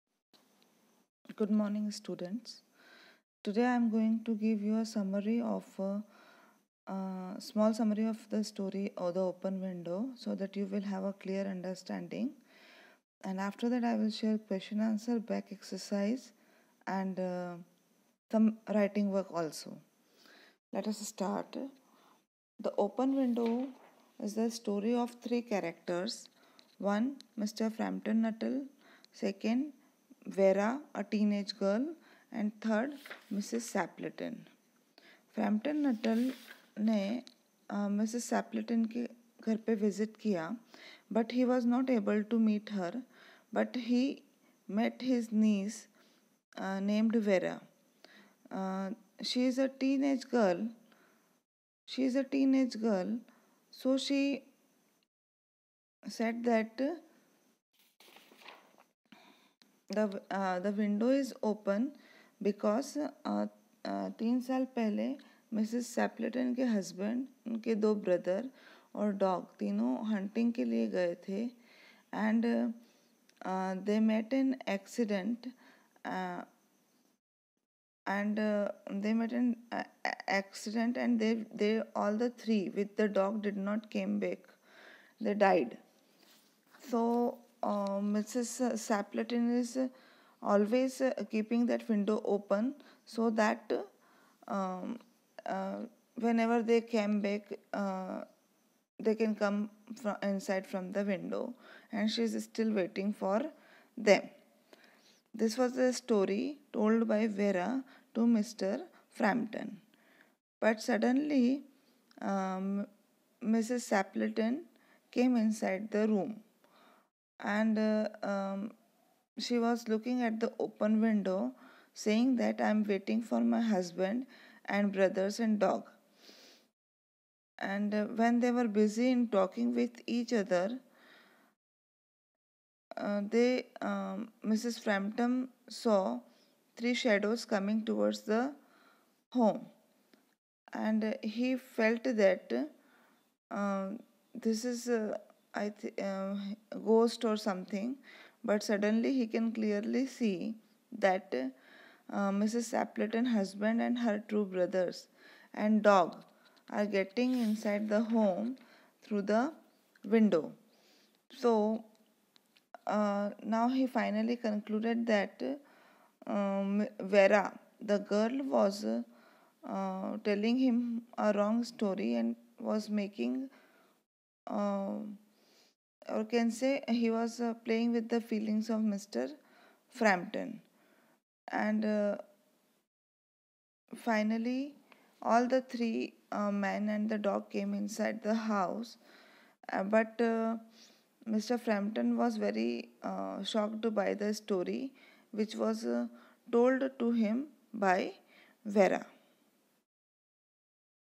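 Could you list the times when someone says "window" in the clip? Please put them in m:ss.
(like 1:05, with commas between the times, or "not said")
0:09, 0:23, 1:31, 1:41, 2:01, 2:40.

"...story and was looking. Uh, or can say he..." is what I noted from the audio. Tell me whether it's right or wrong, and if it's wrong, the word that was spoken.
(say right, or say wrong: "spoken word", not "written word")
wrong: "making", not "looking".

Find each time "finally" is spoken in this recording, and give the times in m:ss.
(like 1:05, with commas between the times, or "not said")
2:43, 3:03.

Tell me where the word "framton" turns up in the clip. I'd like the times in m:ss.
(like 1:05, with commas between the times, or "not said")
0:27, 0:35, 1:49, 2:14, 2:59, 3:11.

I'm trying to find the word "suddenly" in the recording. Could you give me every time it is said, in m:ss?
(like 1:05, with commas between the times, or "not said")
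1:50, 2:28.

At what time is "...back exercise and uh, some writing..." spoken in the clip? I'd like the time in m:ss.
0:15.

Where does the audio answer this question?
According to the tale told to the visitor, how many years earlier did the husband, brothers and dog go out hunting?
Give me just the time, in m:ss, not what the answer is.
1:04.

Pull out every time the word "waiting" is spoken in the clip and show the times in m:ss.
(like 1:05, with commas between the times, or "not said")
1:42, 2:02.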